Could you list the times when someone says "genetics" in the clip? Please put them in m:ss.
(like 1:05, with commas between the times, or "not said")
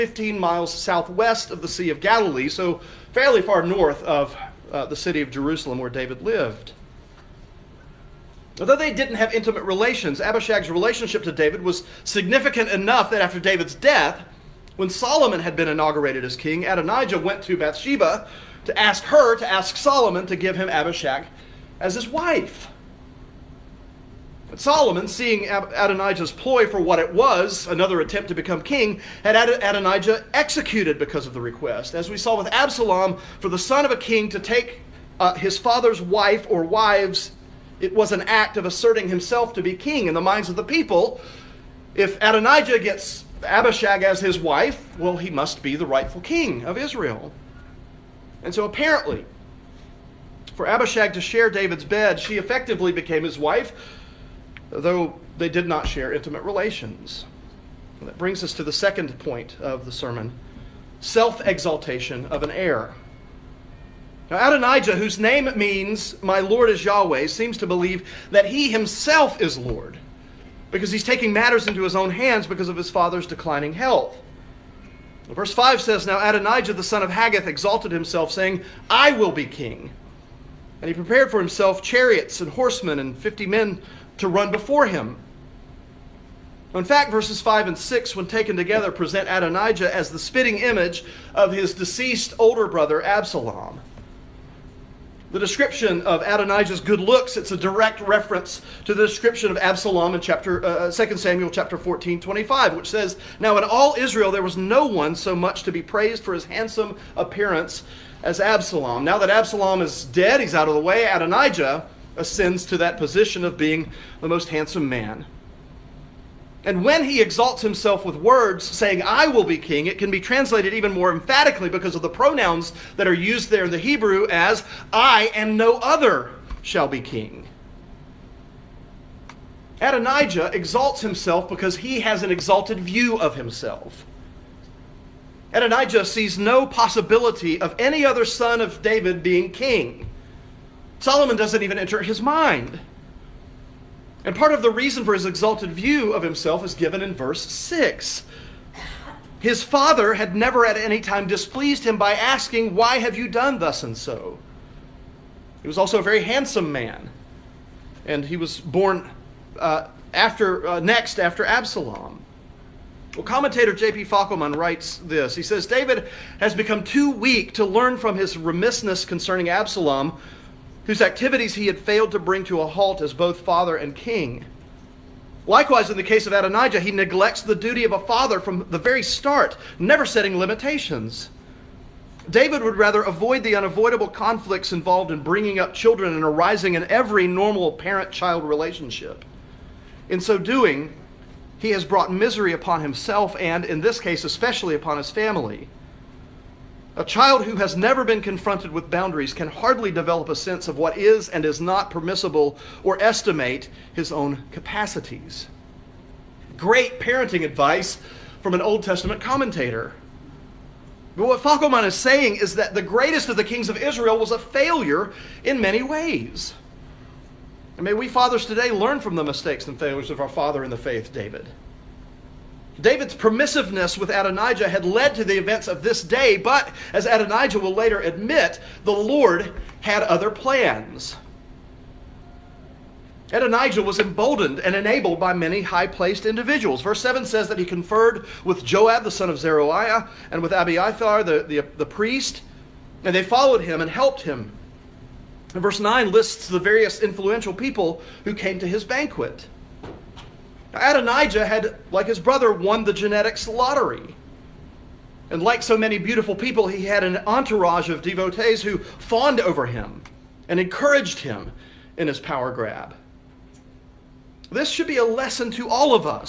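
4:12.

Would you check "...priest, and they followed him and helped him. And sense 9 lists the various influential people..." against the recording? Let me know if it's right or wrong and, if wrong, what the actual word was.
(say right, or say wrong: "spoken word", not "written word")
wrong: "verse", not "sense".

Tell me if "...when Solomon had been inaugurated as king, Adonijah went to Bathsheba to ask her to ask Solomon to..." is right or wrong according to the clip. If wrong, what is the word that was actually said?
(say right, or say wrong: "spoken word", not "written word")
right.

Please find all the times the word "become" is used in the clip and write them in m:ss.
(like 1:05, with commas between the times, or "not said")
0:28, 2:46.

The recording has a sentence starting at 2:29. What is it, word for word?
His father had never at any time displeased him by asking, Why have you done thus and so?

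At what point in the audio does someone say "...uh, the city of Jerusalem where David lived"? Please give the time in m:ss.
0:04.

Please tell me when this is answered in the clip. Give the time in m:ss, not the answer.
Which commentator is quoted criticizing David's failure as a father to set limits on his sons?
2:43.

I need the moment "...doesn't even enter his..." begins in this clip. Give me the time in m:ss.
2:21.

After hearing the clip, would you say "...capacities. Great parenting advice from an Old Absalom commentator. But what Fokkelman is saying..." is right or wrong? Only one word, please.
wrong.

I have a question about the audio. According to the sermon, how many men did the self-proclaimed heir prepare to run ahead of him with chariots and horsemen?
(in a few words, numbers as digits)
50.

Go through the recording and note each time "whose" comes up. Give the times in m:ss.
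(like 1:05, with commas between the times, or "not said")
1:04, 2:50.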